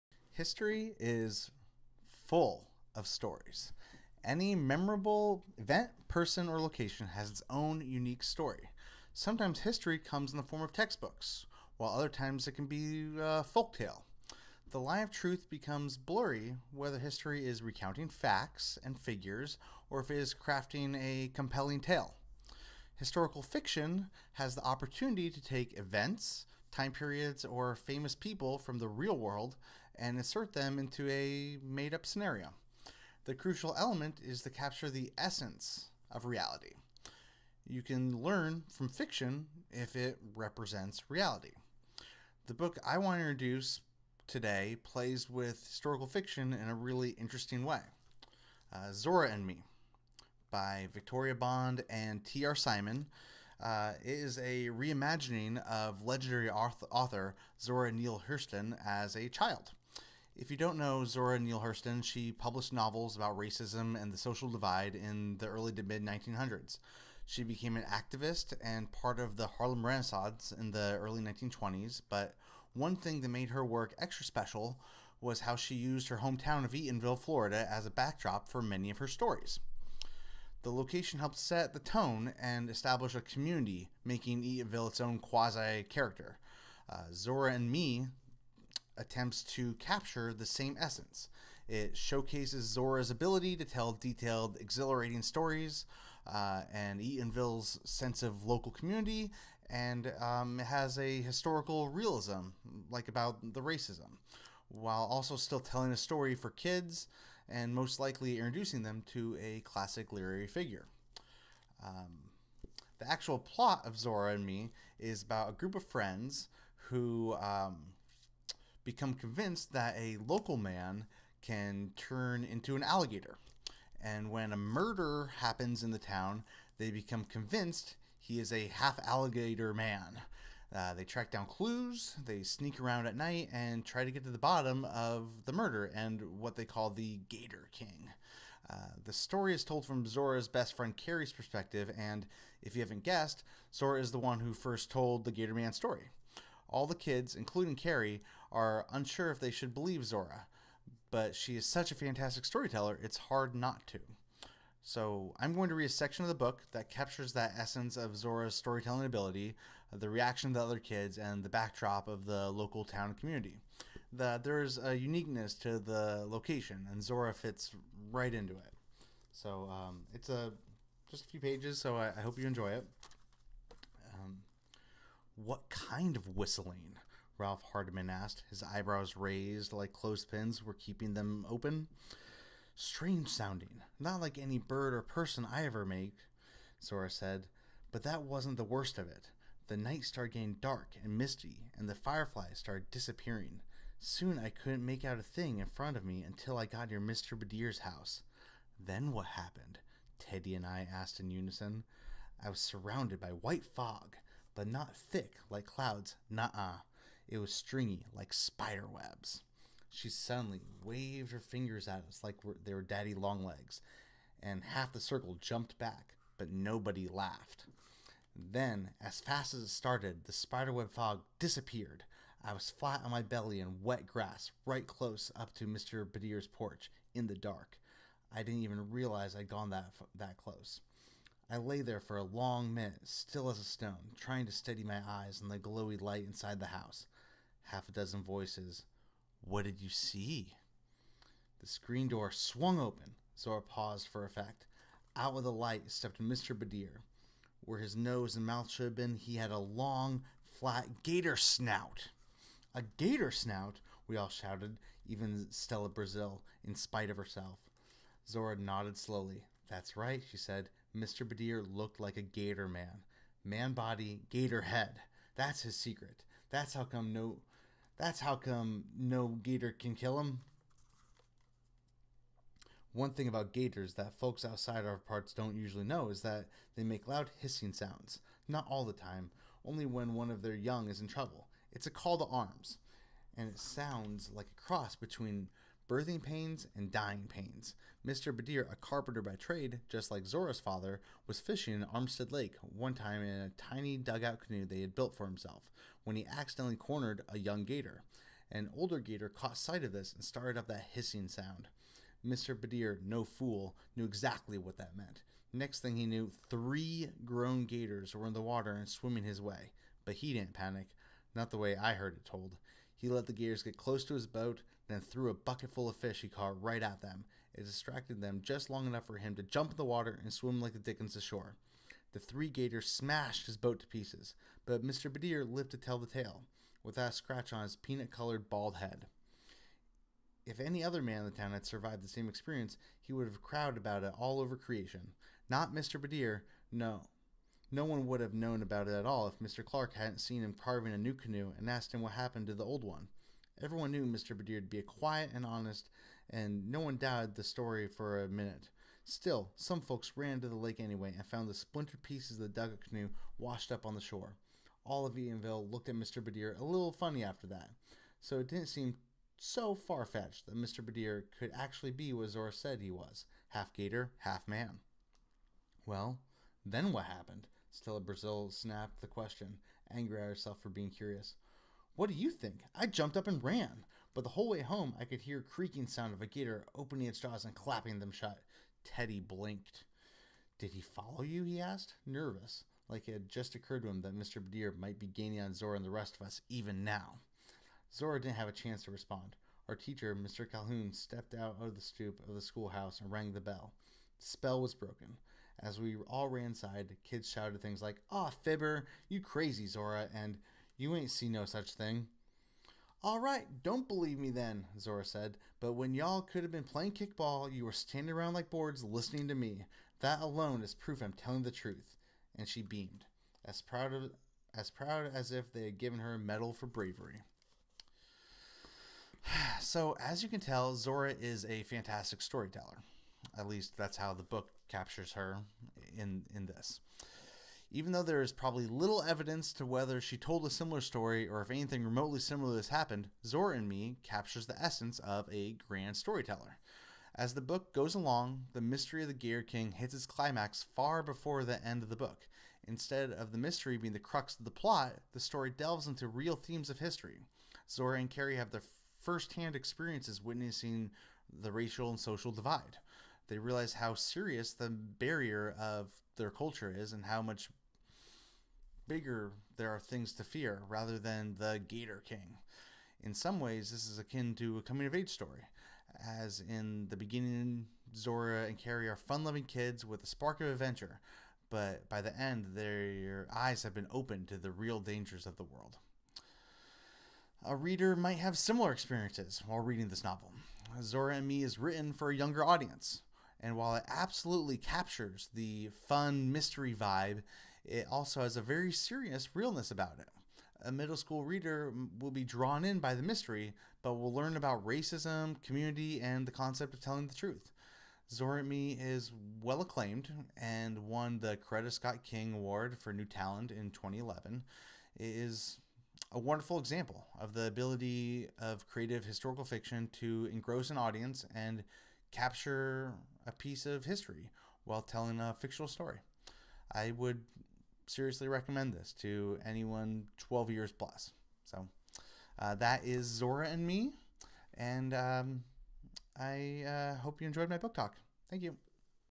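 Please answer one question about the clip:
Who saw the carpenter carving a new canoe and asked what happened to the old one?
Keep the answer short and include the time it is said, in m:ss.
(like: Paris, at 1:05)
Mr. Clark, at 5:39.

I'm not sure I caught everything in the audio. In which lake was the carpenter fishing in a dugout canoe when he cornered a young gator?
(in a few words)
Armstead Lake.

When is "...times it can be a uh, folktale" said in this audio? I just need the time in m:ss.
0:12.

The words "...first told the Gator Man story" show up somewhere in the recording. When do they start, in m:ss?
2:24.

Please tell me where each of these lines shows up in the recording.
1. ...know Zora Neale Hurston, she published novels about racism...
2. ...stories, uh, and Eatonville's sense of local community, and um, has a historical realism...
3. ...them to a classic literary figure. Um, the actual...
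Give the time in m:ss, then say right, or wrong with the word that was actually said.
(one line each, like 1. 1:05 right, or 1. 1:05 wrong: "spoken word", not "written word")
1. 1:00 right
2. 1:35 right
3. 1:48 right.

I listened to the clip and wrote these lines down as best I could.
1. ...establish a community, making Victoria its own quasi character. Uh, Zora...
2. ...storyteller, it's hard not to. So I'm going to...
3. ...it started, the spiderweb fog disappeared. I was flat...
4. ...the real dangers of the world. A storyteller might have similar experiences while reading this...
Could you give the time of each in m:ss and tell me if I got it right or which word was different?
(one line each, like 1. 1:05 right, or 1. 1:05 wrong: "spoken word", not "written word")
1. 1:22 wrong: "Eatonville", not "Victoria"
2. 2:32 right
3. 3:39 right
4. 7:54 wrong: "reader", not "storyteller".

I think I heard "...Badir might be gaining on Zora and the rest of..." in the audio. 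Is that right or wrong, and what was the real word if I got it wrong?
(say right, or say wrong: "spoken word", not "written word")
right.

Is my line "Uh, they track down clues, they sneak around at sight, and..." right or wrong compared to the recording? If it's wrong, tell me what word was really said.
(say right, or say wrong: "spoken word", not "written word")
wrong: "night", not "sight".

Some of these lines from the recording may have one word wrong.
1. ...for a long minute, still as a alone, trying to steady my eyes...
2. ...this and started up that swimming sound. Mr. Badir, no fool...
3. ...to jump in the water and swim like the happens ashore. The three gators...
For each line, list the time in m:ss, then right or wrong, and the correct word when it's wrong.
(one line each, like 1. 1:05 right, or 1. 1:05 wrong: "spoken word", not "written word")
1. 3:51 wrong: "stone", not "alone"
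2. 4:59 wrong: "hissing", not "swimming"
3. 5:19 wrong: "dickens", not "happens".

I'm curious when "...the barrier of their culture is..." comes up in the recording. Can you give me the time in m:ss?
7:34.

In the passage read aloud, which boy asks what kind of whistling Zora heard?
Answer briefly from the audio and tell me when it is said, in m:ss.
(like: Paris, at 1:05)
Ralph Hardman, at 2:57.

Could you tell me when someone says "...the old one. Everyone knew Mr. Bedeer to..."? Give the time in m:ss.
5:42.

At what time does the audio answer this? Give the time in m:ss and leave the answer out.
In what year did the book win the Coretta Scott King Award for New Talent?
8:23.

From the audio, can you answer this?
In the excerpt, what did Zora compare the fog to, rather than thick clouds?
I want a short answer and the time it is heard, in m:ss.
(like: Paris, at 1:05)
Spider webs, at 3:28.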